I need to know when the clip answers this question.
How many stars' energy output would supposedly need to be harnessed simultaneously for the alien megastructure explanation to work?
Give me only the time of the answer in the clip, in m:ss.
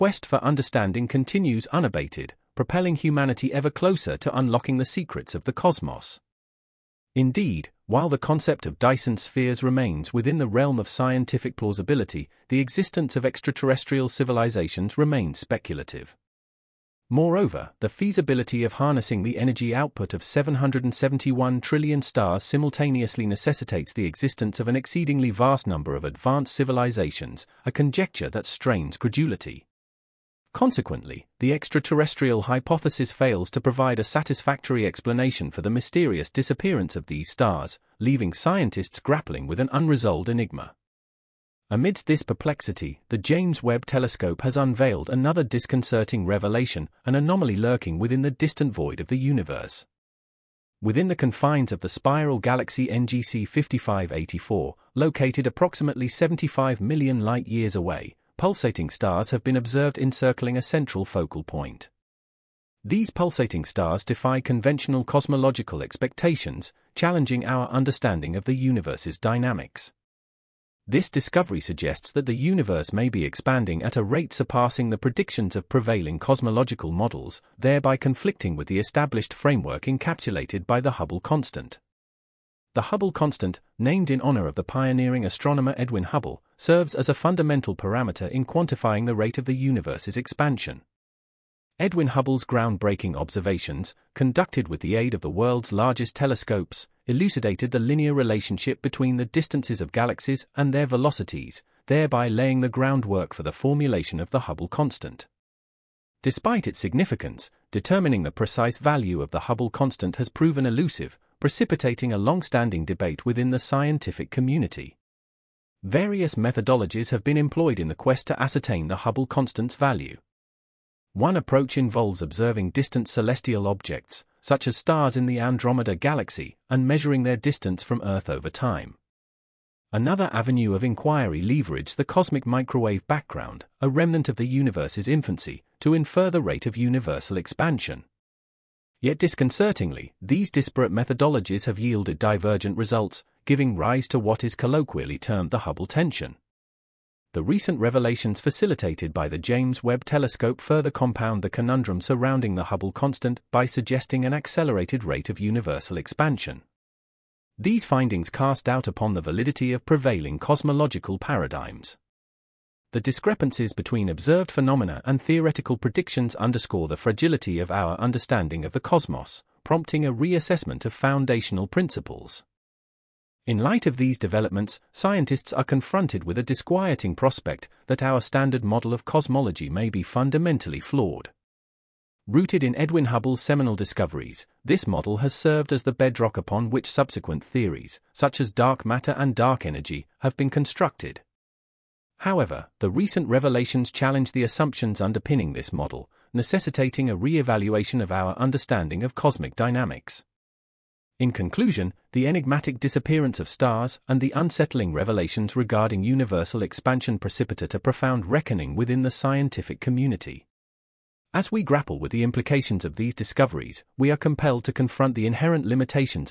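0:20.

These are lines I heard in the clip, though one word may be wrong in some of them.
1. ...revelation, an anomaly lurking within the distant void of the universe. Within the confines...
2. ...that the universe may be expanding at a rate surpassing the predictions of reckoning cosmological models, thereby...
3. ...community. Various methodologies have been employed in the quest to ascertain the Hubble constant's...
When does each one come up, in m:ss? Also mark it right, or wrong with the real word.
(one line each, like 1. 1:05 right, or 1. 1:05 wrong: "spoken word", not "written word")
1. 0:46 right
2. 1:12 wrong: "prevailing", not "reckoning"
3. 1:54 right.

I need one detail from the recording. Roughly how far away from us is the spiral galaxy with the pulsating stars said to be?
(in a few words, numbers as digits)
75 million light-years.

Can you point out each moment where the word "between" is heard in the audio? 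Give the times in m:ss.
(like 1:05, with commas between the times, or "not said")
1:38, 2:43.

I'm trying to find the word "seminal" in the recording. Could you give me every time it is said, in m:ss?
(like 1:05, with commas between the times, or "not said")
3:03.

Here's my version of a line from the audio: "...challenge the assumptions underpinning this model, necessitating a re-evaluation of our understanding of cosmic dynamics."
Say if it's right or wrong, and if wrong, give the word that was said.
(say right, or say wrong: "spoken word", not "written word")
right.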